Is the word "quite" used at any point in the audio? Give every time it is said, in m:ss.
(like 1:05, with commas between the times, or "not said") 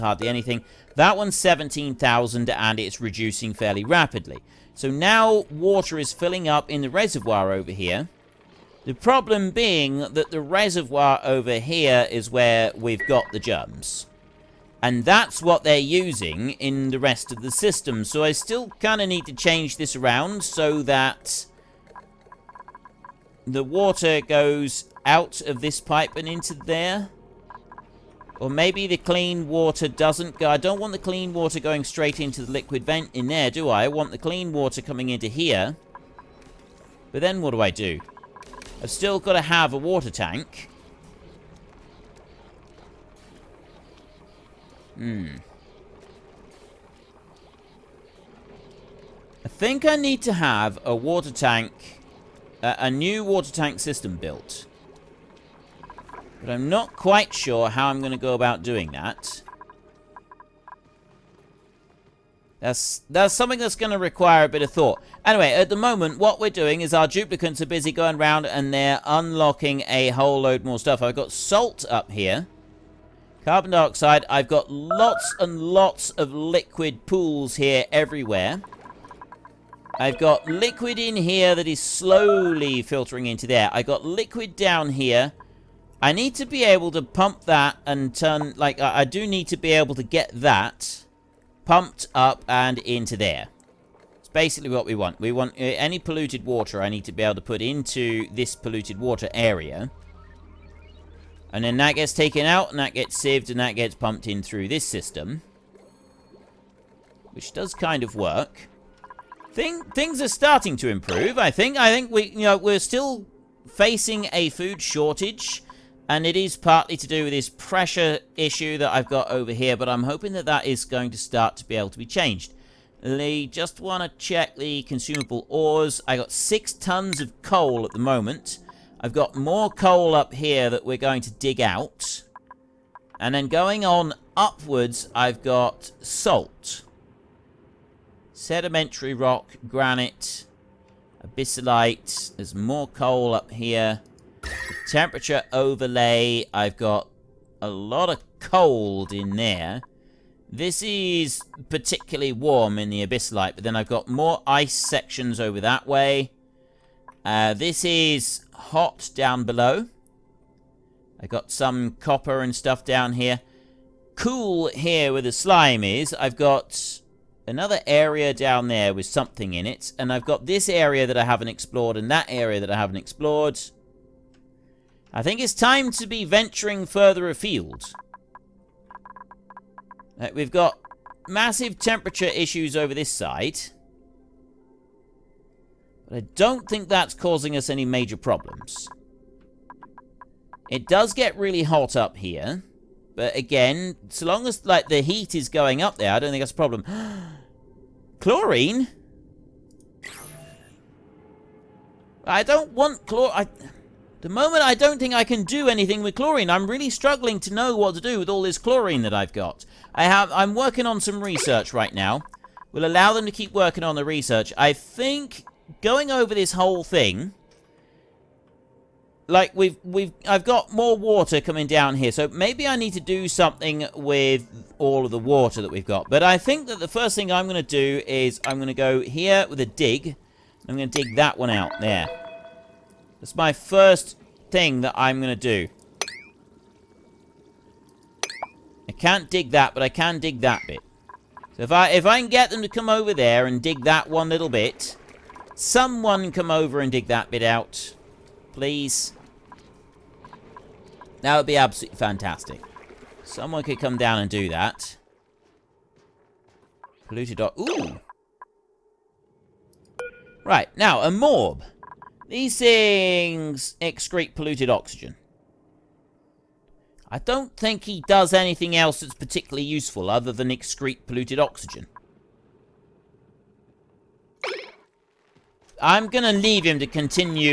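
0:56.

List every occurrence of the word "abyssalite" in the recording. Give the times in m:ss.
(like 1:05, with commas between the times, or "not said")
2:21, 2:33.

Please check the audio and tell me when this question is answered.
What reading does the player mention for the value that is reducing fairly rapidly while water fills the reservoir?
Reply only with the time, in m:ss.
0:01.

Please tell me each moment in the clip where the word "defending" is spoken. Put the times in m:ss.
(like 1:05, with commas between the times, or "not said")
not said.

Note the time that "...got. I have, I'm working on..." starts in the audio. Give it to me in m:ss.
3:29.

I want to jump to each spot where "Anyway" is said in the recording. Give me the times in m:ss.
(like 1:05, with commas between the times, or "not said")
1:05.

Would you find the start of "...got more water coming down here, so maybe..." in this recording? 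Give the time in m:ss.
3:40.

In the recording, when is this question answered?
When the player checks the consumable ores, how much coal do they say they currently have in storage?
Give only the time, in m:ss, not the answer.
2:06.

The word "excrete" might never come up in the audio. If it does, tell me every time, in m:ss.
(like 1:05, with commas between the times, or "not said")
4:23, 4:30.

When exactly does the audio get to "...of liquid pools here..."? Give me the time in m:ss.
1:16.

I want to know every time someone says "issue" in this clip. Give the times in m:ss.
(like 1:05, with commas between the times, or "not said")
1:58, 3:02.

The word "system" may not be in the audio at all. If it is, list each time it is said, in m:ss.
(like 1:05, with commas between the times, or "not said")
0:17, 0:53, 1:44.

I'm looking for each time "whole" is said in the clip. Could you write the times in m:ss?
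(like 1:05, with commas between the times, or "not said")
1:10, 3:36.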